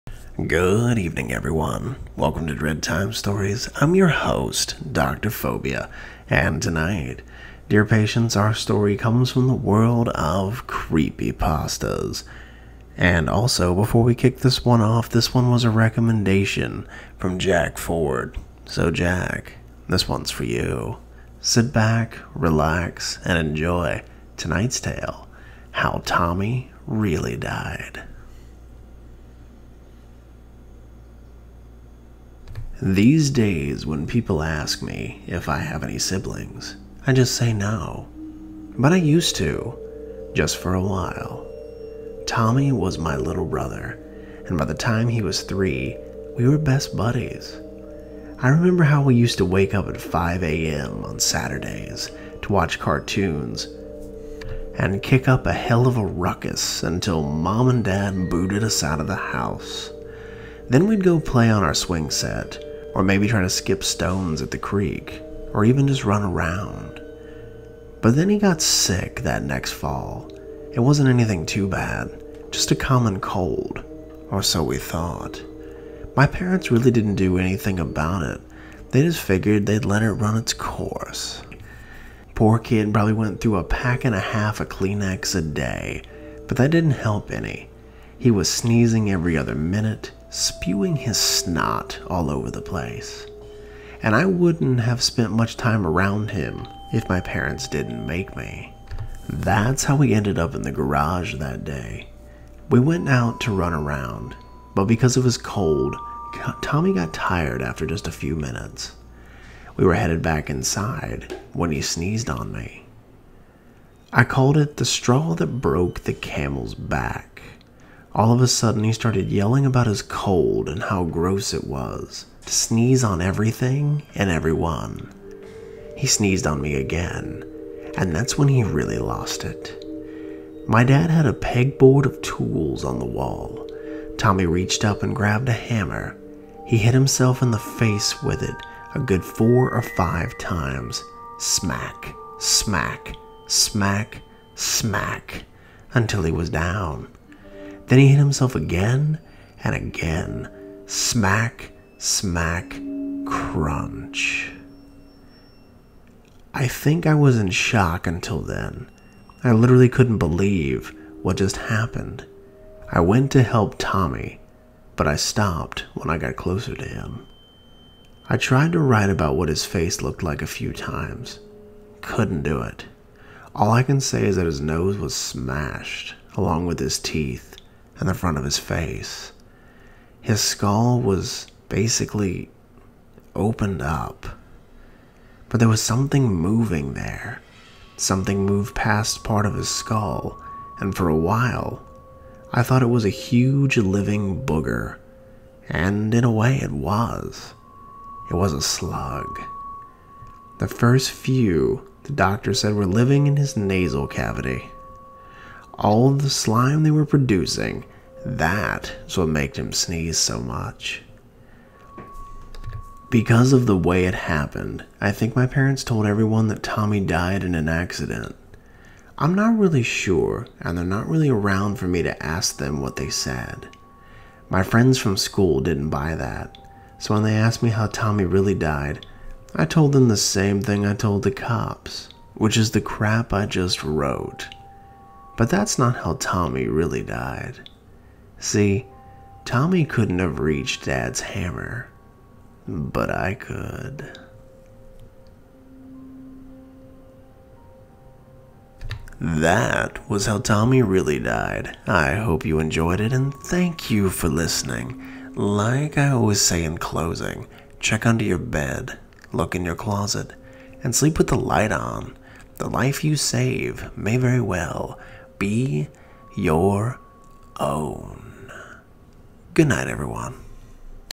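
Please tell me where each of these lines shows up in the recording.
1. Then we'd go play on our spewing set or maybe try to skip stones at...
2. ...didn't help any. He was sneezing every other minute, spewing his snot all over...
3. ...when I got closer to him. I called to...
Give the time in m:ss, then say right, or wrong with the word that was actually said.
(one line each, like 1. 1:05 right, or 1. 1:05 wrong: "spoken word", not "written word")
1. 1:00 wrong: "swing", not "spewing"
2. 1:26 right
3. 2:45 wrong: "tried", not "called".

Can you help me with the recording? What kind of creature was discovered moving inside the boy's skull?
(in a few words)
A slug.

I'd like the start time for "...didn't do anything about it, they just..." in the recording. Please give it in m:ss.
1:16.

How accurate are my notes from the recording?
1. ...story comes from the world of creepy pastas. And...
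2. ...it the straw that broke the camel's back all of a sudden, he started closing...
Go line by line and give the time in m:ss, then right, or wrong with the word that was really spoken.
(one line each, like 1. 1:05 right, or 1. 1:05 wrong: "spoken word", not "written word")
1. 0:08 right
2. 1:54 wrong: "yelling", not "closing".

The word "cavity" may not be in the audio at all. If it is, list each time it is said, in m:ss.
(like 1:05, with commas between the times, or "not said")
3:24.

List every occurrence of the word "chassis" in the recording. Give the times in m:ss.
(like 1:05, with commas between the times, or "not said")
not said.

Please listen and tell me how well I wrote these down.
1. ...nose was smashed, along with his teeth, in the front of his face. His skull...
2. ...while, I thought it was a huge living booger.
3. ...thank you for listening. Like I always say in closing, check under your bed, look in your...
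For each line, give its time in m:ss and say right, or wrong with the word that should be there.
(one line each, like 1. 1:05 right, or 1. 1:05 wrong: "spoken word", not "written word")
1. 2:54 right
2. 3:11 right
3. 4:13 right.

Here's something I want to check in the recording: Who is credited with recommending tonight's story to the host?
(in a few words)
Jack Ford.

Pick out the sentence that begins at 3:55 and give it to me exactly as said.
But that's not how Tommy really died.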